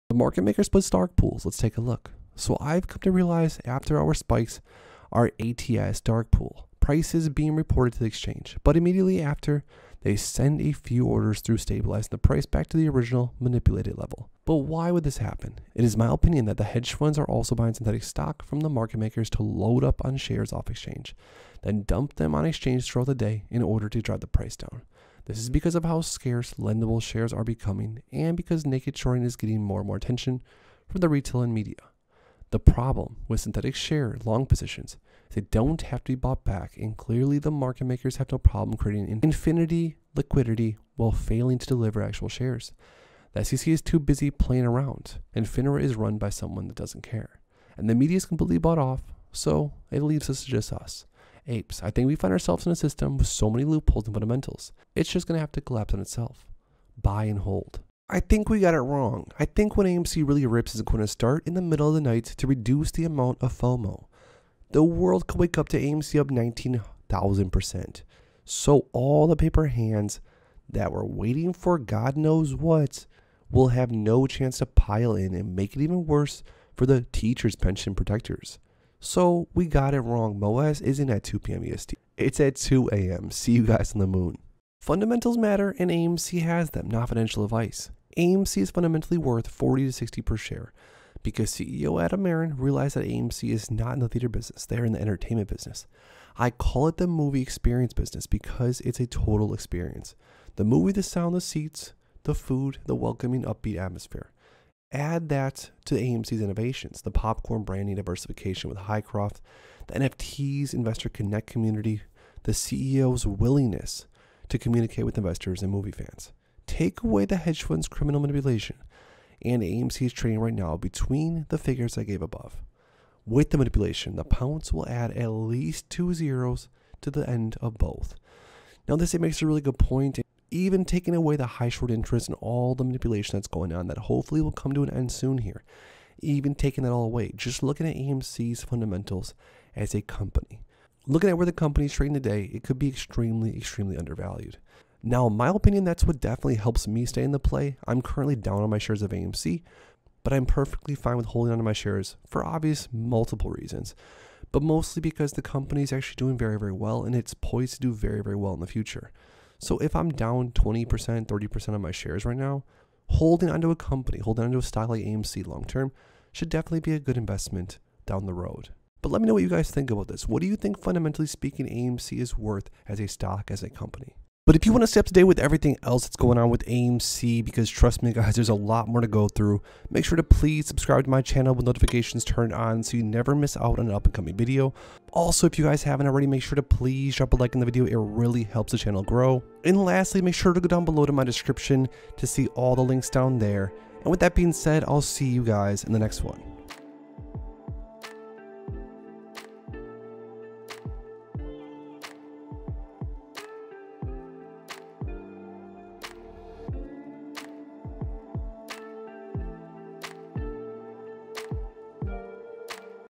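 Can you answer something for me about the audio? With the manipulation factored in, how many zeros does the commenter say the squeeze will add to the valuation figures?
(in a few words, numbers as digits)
2.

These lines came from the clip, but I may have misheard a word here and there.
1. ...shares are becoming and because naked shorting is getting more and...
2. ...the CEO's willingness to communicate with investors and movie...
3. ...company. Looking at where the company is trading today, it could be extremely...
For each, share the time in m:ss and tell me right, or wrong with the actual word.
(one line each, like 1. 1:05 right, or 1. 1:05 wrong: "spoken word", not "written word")
1. 0:27 right
2. 1:52 right
3. 2:20 right.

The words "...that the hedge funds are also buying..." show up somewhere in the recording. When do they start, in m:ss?
0:16.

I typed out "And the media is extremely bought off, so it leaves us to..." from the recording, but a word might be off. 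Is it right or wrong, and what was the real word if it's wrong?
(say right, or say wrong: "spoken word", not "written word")
wrong: "completely", not "extremely".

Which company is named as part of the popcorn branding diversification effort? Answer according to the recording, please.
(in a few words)
Hycroft.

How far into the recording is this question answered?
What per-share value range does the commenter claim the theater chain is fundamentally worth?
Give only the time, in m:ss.
1:29.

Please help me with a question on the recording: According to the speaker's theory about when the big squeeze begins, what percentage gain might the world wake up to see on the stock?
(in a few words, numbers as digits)
19,000%.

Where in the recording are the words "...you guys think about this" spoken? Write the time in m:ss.
2:49.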